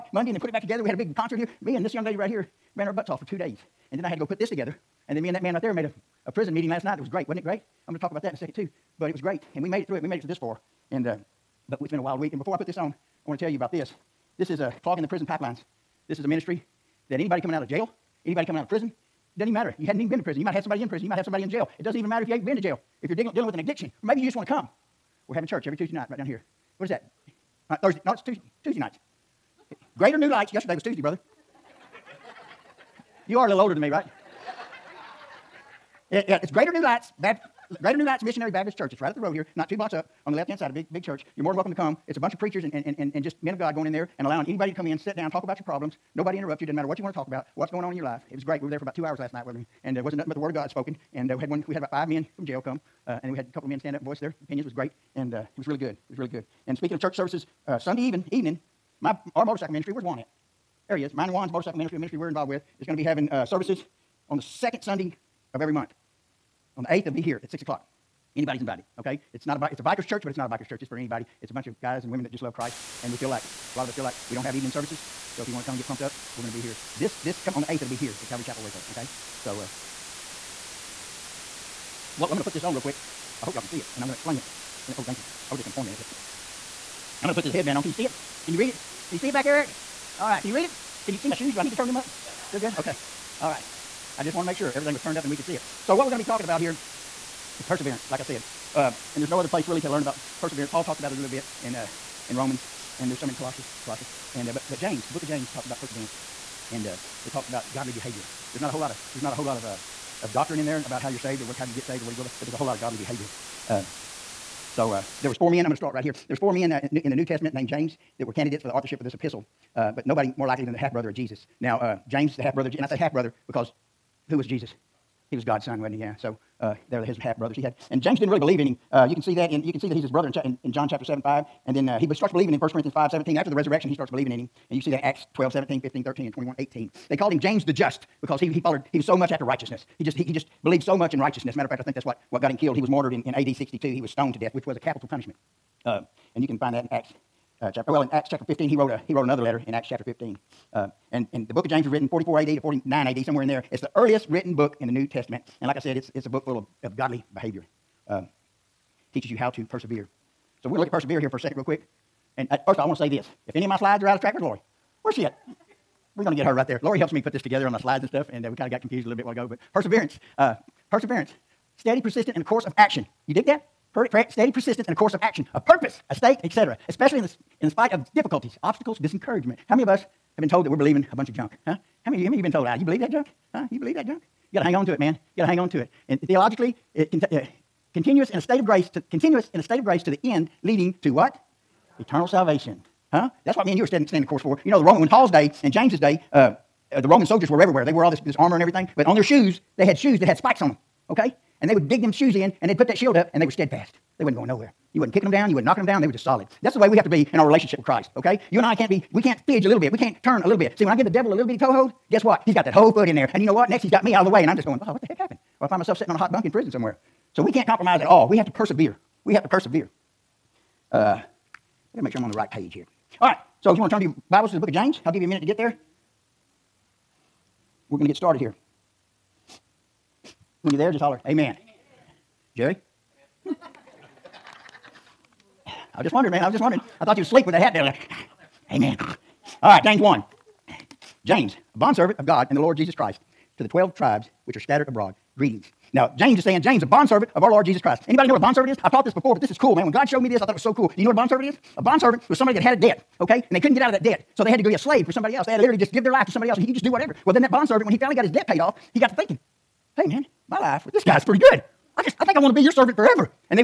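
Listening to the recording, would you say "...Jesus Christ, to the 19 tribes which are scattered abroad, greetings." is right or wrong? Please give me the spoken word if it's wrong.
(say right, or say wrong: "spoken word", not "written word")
wrong: "12", not "19".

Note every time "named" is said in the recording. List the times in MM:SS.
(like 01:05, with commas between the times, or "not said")
01:57.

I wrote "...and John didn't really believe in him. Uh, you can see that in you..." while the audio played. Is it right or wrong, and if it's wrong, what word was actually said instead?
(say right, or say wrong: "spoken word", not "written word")
wrong: "James", not "John".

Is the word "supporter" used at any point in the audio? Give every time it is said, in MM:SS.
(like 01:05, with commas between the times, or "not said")
not said.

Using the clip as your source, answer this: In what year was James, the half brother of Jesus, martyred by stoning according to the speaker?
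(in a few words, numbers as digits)
AD 62.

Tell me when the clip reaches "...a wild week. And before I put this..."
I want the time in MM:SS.
00:11.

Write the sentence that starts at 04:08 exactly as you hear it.
I've taught this before, but this is cool, man.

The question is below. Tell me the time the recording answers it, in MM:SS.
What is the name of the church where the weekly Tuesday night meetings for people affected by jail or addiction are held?
00:37.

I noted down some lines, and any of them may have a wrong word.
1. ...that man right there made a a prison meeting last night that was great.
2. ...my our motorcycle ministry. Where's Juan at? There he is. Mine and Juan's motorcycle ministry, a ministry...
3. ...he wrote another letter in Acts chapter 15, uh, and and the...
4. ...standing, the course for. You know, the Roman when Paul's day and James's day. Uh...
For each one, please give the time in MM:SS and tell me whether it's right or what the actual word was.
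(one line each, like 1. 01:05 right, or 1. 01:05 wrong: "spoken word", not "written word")
1. 00:05 right
2. 00:59 right
3. 02:29 right
4. 03:13 right.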